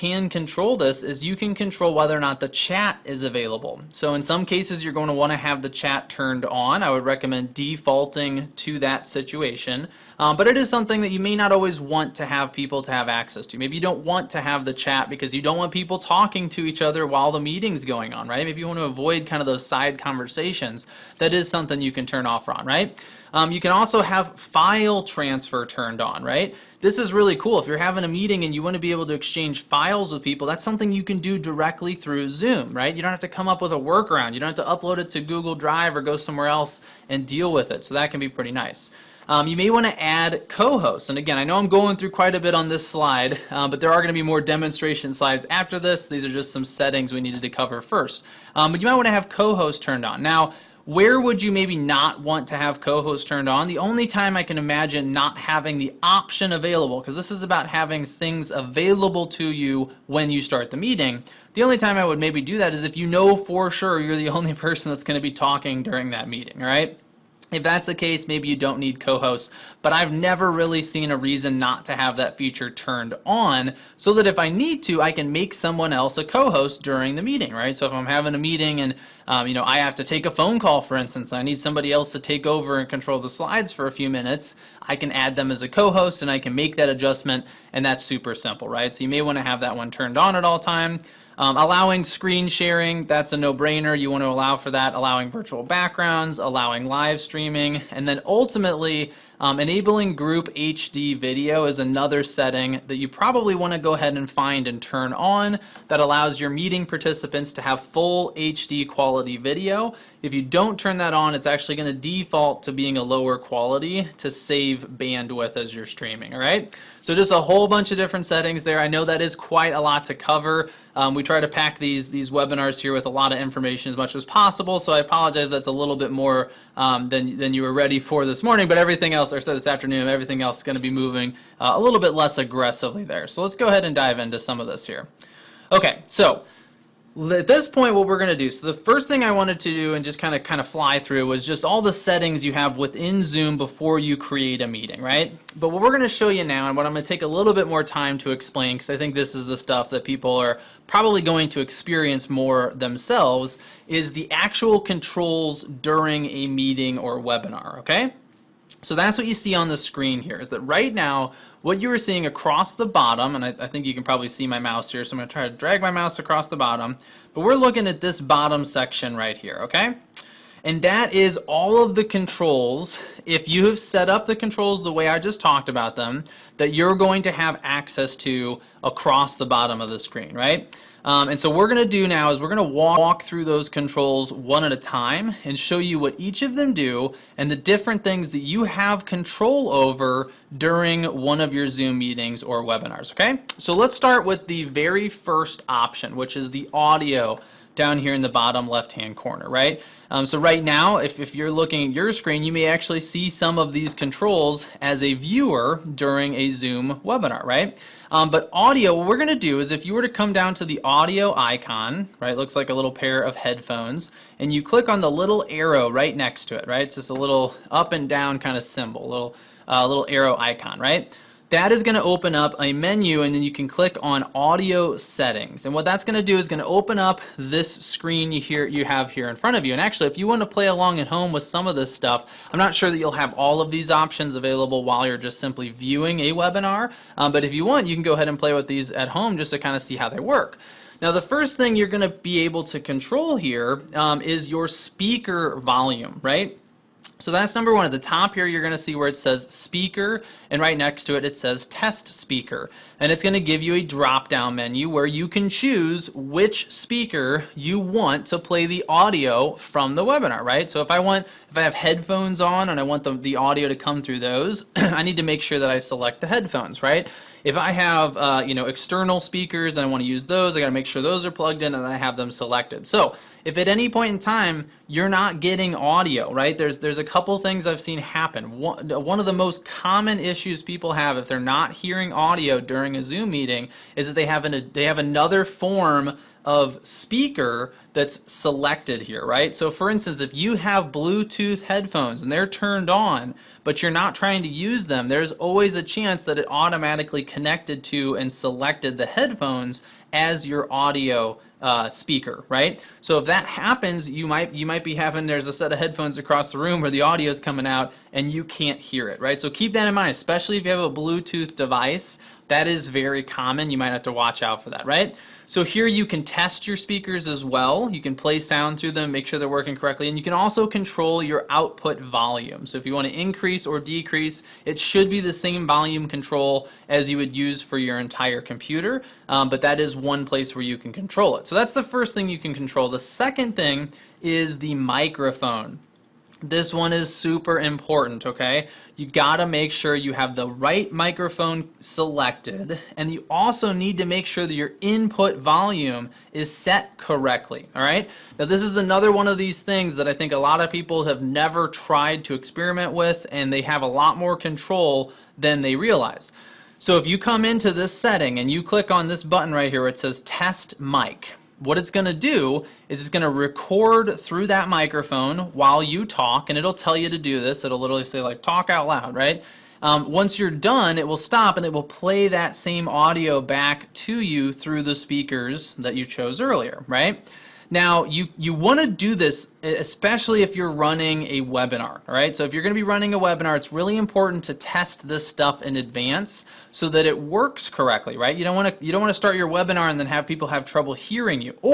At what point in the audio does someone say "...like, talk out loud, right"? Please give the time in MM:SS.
06:08.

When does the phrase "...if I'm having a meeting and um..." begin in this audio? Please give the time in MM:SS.
01:17.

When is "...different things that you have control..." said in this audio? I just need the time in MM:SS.
03:07.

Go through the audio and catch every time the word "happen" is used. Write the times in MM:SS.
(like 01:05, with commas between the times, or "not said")
04:37, 05:03.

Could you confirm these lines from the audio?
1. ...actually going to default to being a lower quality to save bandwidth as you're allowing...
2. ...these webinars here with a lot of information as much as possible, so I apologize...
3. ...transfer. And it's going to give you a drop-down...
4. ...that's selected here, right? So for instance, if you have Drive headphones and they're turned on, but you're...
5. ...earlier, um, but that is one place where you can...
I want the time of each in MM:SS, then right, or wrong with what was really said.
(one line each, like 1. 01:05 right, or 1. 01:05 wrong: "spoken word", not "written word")
1. 01:51 wrong: "streaming", not "allowing"
2. 02:02 right
3. 04:12 wrong: "speaker", not "transfer"
4. 04:47 wrong: "Bluetooth", not "Drive"
5. 05:28 wrong: "computer", not "earlier".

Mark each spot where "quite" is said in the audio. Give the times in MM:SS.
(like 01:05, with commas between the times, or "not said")
00:42, 01:59.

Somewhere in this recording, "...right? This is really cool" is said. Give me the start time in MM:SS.
00:26.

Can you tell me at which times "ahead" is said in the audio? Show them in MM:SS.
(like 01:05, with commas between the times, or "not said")
01:43, 02:13, 03:58.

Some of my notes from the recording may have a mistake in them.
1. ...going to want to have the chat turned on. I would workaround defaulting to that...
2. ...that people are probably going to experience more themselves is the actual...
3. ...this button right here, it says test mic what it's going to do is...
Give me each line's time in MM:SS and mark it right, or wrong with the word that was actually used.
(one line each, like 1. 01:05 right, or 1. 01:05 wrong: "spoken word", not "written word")
1. 00:04 wrong: "recommend", not "workaround"
2. 02:29 right
3. 05:59 right.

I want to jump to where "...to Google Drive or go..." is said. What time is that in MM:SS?
00:35.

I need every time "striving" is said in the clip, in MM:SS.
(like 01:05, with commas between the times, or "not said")
not said.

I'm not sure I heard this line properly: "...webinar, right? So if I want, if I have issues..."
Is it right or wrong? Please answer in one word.
wrong.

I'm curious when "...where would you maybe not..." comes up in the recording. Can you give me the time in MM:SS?
00:50.